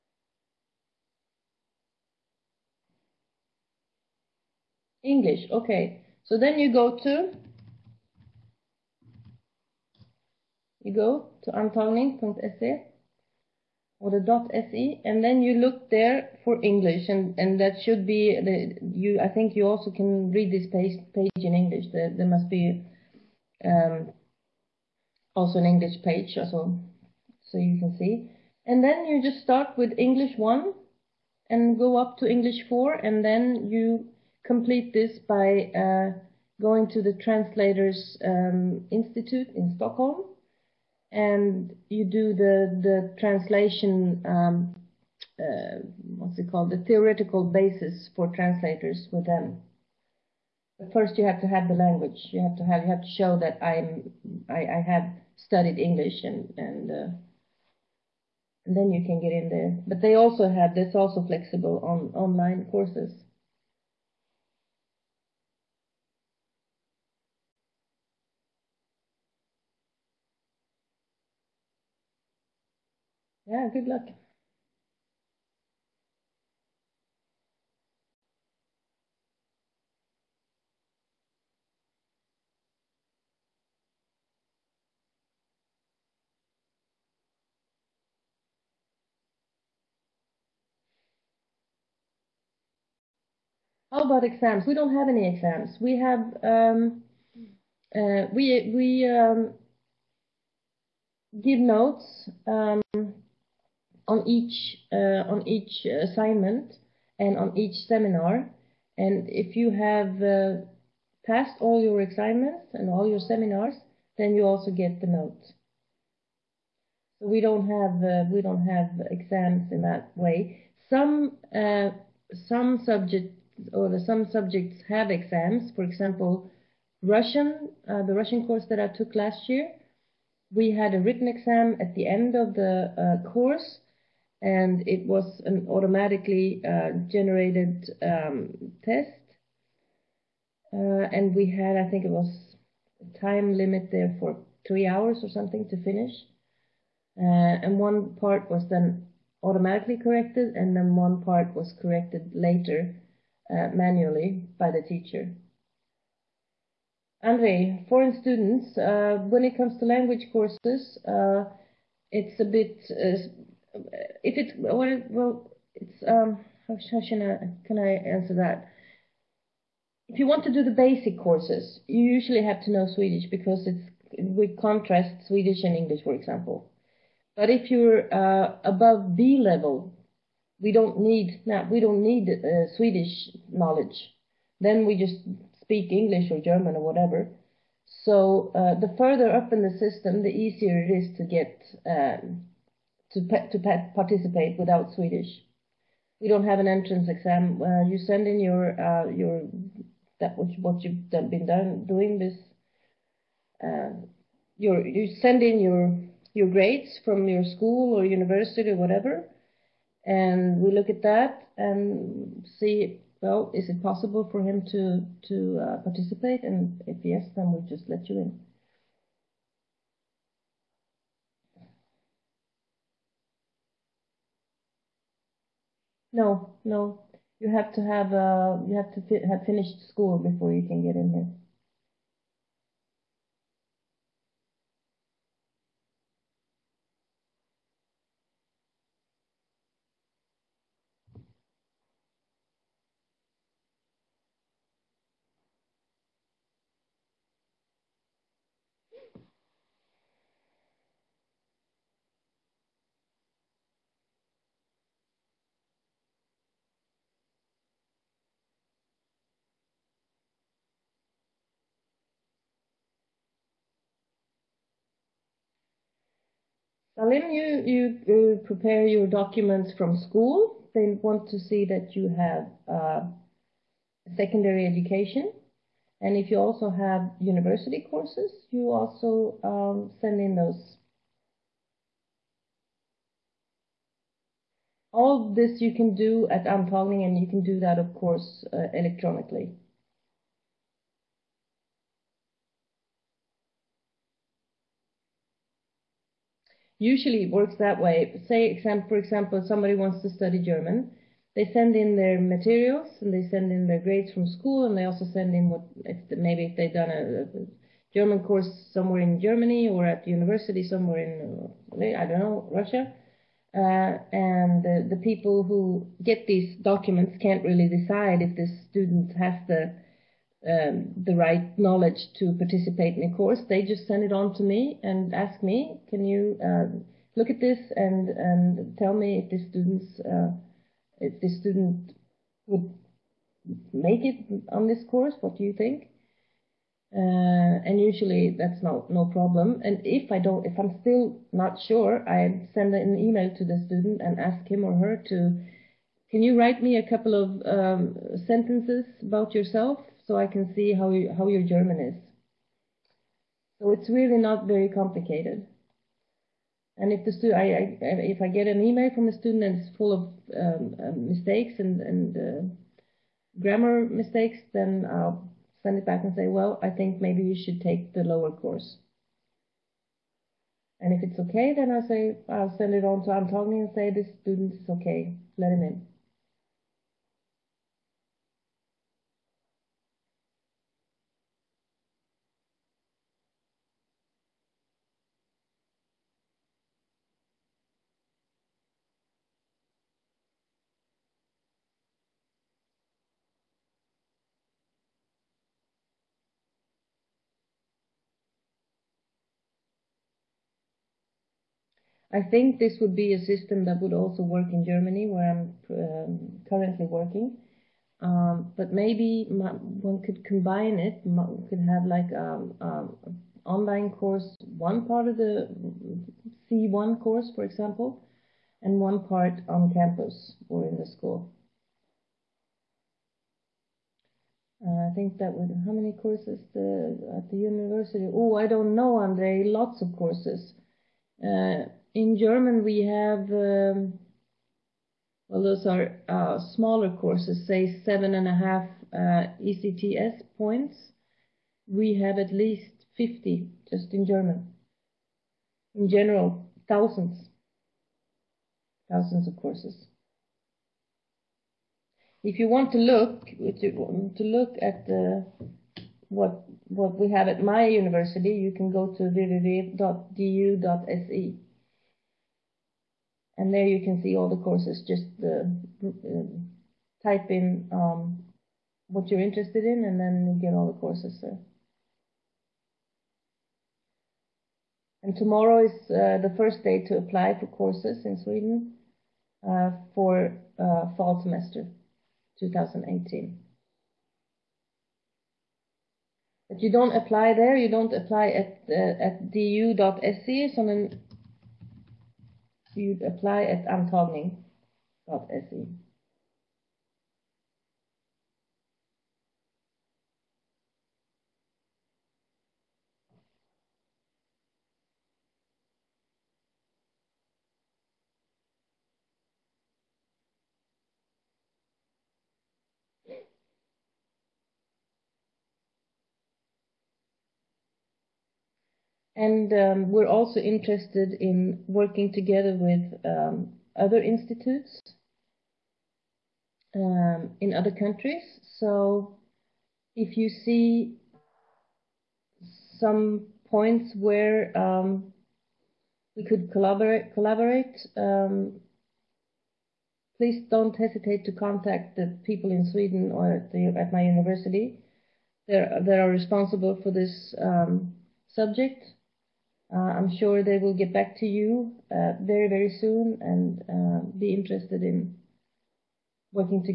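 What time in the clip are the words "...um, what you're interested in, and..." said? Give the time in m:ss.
7:47.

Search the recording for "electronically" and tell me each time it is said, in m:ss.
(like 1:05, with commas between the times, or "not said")
4:48.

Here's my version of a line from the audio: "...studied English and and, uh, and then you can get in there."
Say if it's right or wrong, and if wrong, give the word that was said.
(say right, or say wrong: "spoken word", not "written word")
right.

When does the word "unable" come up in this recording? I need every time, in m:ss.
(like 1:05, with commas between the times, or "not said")
not said.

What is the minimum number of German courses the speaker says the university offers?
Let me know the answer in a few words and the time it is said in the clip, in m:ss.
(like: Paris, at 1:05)
50, at 7:22.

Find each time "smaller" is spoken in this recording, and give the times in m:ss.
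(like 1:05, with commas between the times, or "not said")
7:16.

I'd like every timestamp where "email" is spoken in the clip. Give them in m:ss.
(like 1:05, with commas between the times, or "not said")
5:42, 5:58.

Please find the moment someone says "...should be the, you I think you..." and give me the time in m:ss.
0:17.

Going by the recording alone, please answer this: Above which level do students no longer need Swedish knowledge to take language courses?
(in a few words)
B level.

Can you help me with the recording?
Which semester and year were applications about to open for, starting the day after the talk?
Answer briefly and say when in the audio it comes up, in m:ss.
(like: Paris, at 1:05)
Fall semester 2018, at 8:00.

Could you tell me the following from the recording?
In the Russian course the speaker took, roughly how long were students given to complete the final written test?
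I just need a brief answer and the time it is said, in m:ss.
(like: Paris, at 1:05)
3 hours, at 2:24.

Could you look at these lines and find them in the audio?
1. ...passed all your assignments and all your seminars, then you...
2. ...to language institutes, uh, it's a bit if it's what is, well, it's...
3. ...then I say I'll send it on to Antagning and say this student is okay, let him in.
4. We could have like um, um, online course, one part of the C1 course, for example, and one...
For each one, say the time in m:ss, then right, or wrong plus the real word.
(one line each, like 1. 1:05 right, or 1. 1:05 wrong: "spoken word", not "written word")
1. 1:51 right
2. 2:39 wrong: "courses", not "institutes"
3. 6:11 right
4. 6:51 right.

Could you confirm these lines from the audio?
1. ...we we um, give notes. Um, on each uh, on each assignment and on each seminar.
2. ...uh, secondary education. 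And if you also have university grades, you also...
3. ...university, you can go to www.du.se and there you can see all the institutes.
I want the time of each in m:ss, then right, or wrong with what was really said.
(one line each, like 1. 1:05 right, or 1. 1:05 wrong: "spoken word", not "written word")
1. 1:38 right
2. 4:32 wrong: "courses", not "grades"
3. 7:37 wrong: "courses", not "institutes".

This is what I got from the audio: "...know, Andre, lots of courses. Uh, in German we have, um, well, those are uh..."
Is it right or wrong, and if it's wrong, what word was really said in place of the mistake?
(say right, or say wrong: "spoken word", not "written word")
right.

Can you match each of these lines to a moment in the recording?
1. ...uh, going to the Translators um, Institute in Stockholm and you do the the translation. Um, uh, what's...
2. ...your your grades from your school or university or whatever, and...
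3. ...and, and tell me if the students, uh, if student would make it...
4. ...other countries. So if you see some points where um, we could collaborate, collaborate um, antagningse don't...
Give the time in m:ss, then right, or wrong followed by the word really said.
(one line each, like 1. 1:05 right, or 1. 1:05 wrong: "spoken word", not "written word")
1. 0:35 right
2. 3:25 right
3. 5:27 right
4. 8:47 wrong: "please", not "antagningse".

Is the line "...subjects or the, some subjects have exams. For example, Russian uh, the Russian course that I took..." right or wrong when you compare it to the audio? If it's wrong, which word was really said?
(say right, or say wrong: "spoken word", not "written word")
right.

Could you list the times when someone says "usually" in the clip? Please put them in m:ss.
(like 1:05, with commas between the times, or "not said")
2:52, 4:56, 5:37.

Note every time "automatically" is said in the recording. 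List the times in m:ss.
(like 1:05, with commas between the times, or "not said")
2:15, 2:29.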